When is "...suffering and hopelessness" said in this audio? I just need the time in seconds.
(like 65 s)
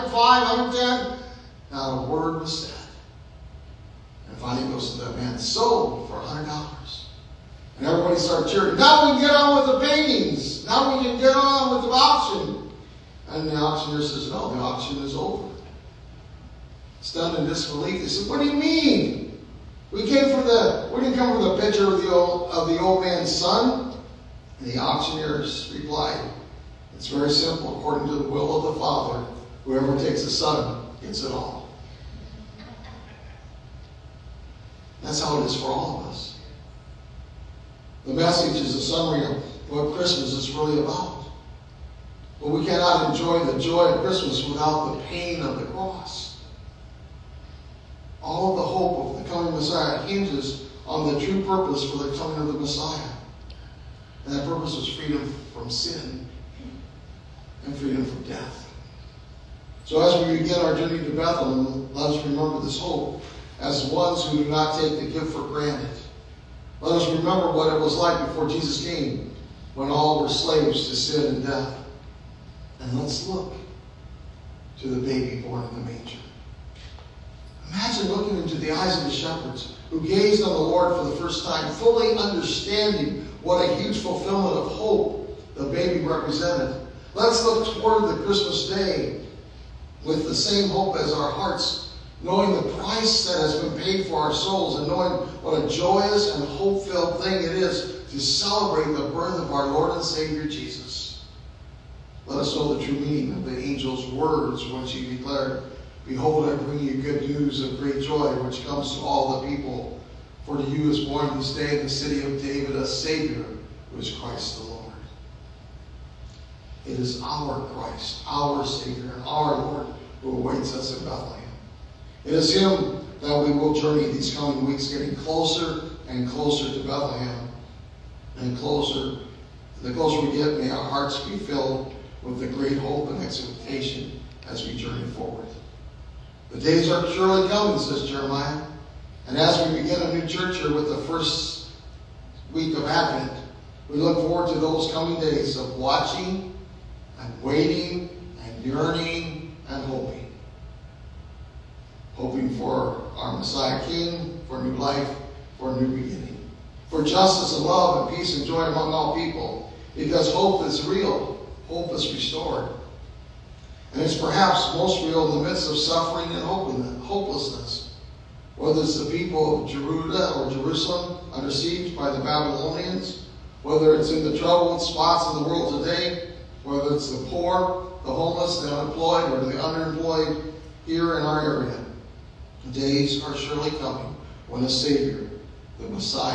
165 s.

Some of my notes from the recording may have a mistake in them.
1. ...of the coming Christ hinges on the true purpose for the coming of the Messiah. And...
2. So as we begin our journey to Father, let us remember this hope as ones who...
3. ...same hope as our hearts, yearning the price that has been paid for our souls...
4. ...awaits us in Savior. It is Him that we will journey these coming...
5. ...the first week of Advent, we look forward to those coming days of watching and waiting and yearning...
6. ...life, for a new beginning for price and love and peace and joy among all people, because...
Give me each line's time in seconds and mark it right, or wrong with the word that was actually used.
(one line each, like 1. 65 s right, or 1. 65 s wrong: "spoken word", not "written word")
1. 49 s wrong: "Messiah", not "Christ"
2. 59 s wrong: "Bethlehem", not "Father"
3. 90 s wrong: "knowing", not "yearning"
4. 120 s wrong: "Bethlehem", not "Savior"
5. 140 s right
6. 154 s wrong: "justice", not "price".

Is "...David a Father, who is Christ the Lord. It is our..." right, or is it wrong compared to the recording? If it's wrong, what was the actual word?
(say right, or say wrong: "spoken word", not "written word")
wrong: "Savior", not "Father".